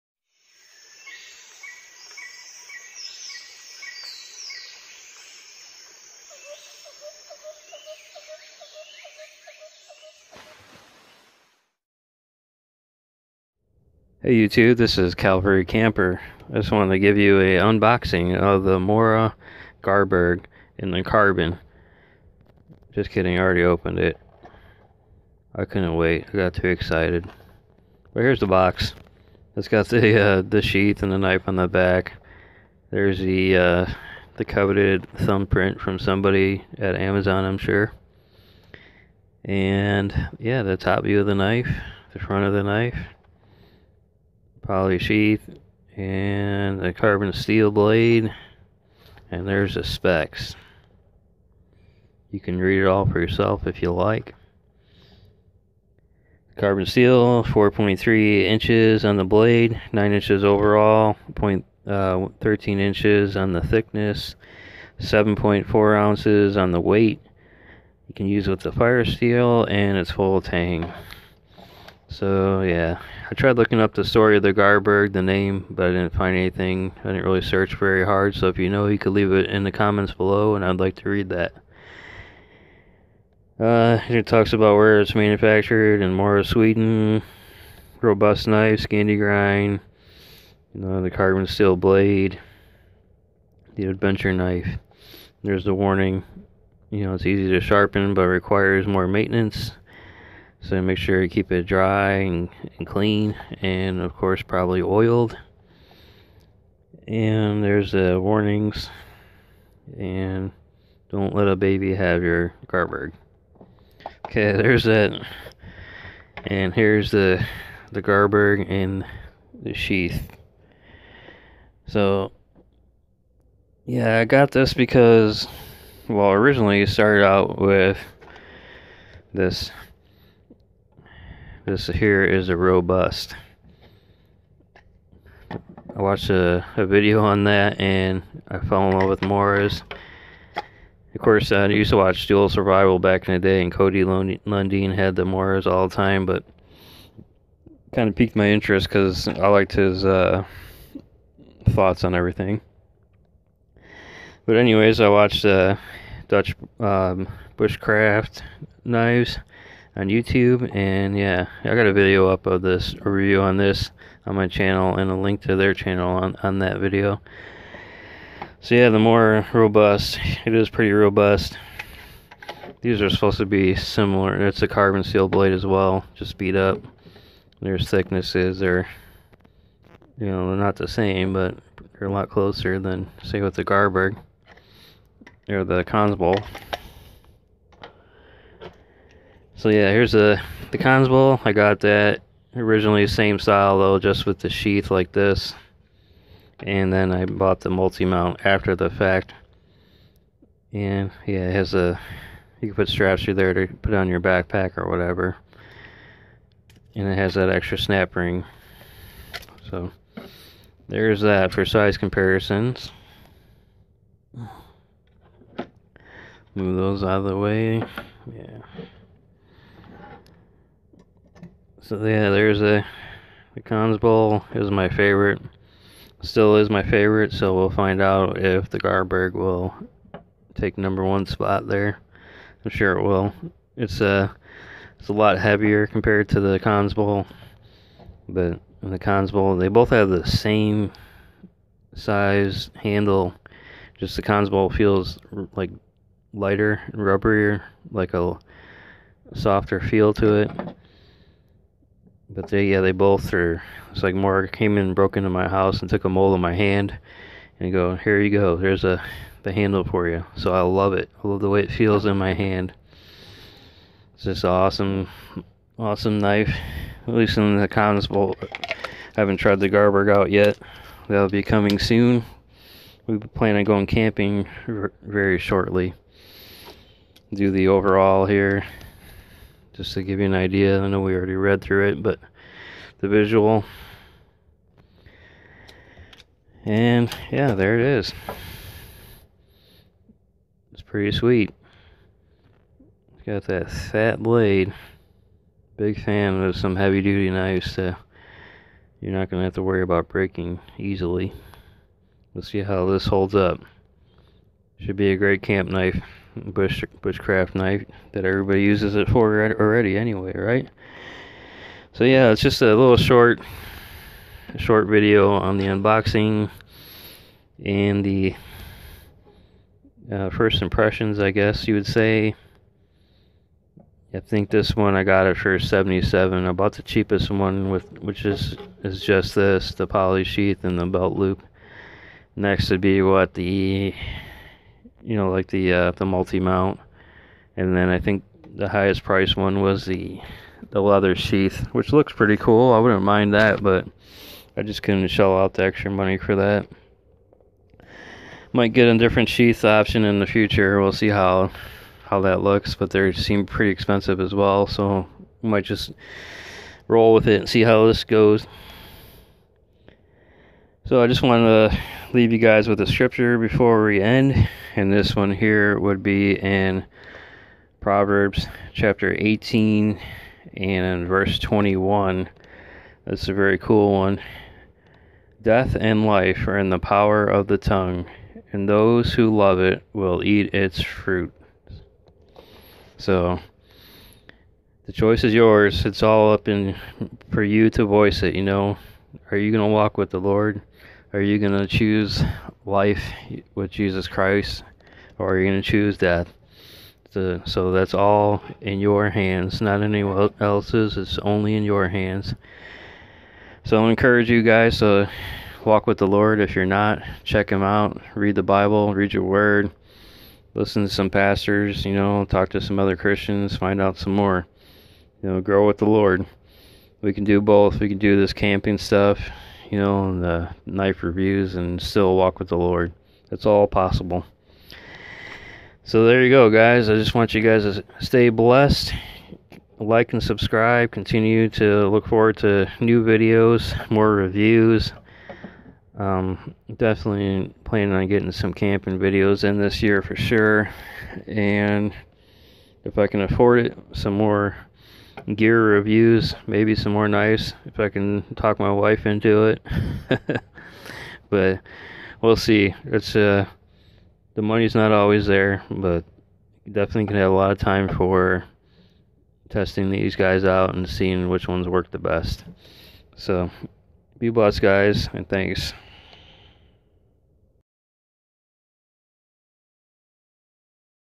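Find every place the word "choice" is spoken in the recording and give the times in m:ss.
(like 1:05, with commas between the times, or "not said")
6:24.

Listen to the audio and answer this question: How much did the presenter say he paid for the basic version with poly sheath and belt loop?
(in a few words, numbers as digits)
77.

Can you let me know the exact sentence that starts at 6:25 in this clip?
It's all up in for you to voice it, you know.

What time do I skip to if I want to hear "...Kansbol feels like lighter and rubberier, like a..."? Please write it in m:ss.
4:04.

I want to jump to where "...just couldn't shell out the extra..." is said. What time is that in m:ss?
5:44.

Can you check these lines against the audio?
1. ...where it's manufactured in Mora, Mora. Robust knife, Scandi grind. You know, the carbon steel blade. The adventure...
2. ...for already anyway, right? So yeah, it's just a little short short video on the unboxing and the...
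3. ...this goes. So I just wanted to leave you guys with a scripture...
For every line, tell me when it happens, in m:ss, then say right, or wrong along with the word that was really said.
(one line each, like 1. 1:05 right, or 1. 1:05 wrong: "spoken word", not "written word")
1. 1:24 wrong: "Sweden", not "Mora"
2. 5:09 right
3. 5:57 right.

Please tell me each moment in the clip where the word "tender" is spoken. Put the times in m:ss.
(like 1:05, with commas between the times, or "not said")
not said.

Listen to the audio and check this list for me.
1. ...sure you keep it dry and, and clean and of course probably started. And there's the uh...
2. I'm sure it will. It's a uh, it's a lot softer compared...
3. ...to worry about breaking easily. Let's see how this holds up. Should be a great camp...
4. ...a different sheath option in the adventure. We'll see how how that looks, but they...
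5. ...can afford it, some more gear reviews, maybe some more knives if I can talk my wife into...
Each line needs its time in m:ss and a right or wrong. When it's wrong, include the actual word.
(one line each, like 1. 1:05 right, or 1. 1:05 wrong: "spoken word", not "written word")
1. 1:40 wrong: "oiled", not "started"
2. 3:52 wrong: "heavier", not "softer"
3. 4:59 right
4. 5:48 wrong: "future", not "adventure"
5. 7:23 right.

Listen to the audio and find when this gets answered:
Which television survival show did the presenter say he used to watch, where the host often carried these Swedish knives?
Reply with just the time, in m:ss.
2:22.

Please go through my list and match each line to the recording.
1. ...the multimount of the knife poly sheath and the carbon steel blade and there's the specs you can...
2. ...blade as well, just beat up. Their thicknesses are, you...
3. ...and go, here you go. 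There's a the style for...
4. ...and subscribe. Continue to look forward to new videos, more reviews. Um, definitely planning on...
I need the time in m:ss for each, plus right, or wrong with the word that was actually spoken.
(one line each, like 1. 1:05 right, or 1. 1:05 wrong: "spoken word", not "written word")
1. 0:42 wrong: "front", not "multimount"
2. 2:55 right
3. 4:17 wrong: "handle", not "style"
4. 7:10 right.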